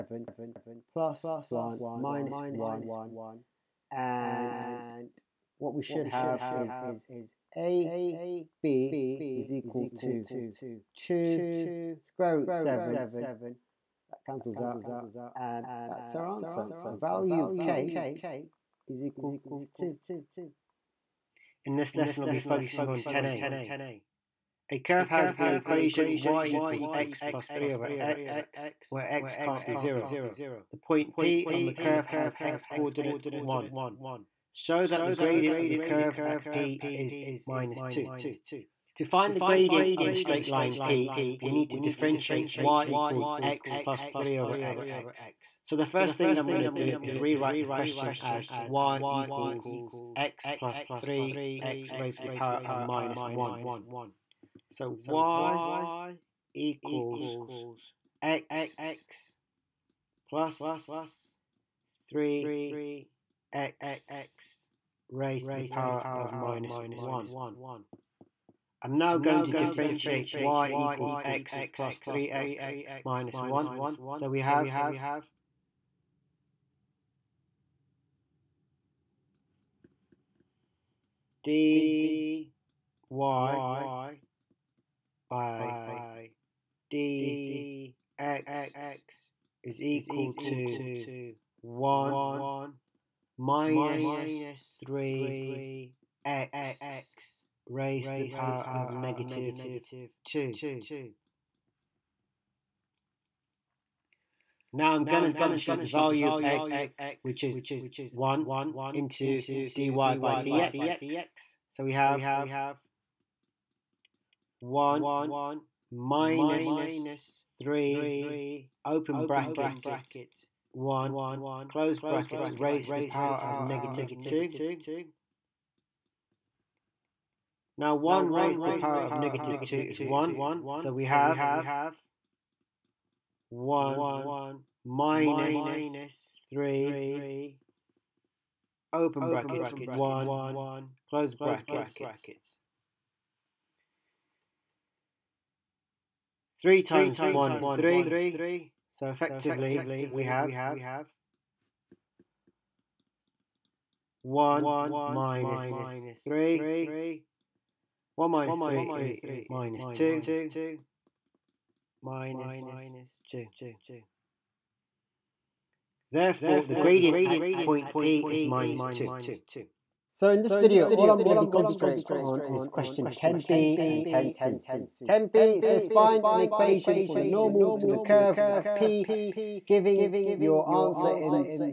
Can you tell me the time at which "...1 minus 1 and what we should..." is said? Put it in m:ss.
0:01.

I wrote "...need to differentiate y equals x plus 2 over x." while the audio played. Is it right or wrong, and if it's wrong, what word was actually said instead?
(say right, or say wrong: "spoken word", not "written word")
wrong: "3", not "2".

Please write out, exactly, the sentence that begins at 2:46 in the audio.
Therefore, the gradient at point P is minus 2.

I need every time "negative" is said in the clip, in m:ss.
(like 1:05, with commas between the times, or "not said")
1:38, 2:03, 2:09.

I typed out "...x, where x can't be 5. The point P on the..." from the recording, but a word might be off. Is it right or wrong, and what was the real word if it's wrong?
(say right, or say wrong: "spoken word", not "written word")
wrong: "0", not "5".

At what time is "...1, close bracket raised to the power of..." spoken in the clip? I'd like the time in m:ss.
2:00.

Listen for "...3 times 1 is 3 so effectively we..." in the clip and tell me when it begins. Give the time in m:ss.
2:26.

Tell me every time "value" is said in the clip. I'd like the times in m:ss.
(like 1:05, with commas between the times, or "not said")
0:16, 1:45.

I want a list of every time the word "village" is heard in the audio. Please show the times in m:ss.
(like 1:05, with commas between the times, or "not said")
not said.